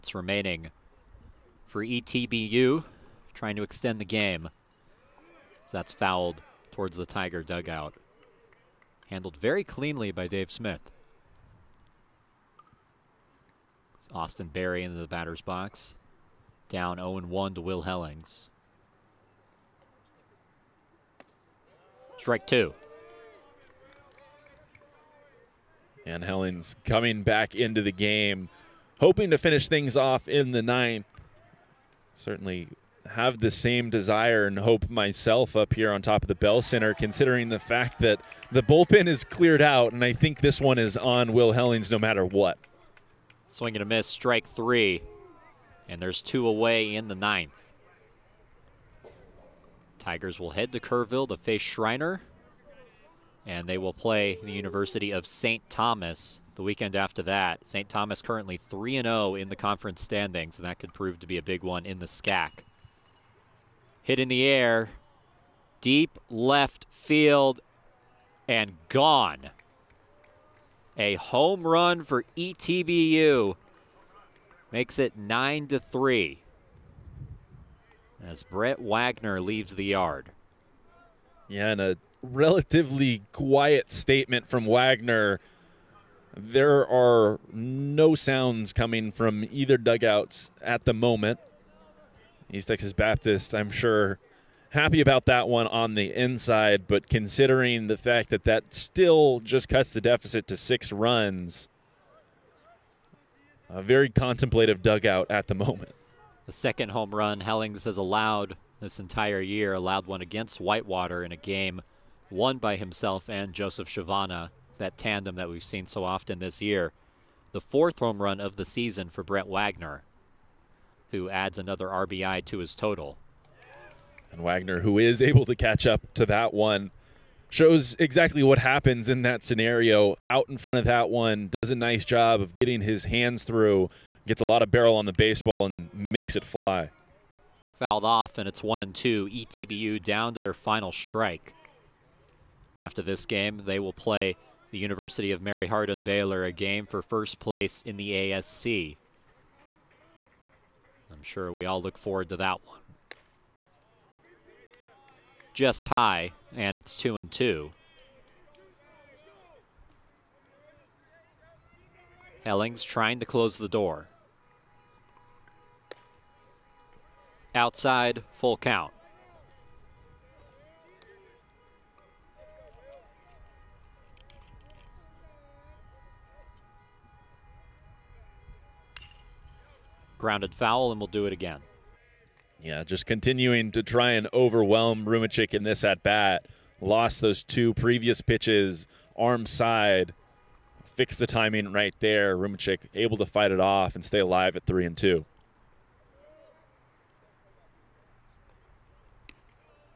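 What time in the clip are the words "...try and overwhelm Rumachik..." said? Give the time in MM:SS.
03:03.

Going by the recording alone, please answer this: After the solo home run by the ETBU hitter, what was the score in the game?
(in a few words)
9 to 3.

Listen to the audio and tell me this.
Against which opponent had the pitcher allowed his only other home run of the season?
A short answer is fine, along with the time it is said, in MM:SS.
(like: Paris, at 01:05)
Whitewater, at 01:50.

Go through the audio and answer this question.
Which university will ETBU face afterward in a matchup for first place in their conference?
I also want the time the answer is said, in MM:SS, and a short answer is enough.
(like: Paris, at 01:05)
University of Mary Hardin Baylor, at 02:24.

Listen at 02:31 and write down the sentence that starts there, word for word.
I'm sure we all look forward to that one just high, and it's two and two.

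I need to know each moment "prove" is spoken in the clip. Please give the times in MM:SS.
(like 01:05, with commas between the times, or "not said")
01:00.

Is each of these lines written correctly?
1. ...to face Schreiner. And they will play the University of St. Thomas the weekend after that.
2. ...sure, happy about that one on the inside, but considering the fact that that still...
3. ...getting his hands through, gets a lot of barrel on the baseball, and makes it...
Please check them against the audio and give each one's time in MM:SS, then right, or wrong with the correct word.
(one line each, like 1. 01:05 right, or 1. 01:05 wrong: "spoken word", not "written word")
1. 00:51 right
2. 01:33 right
3. 02:12 right.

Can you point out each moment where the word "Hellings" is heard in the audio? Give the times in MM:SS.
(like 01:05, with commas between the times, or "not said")
00:17, 00:26, 00:41, 01:47, 02:42.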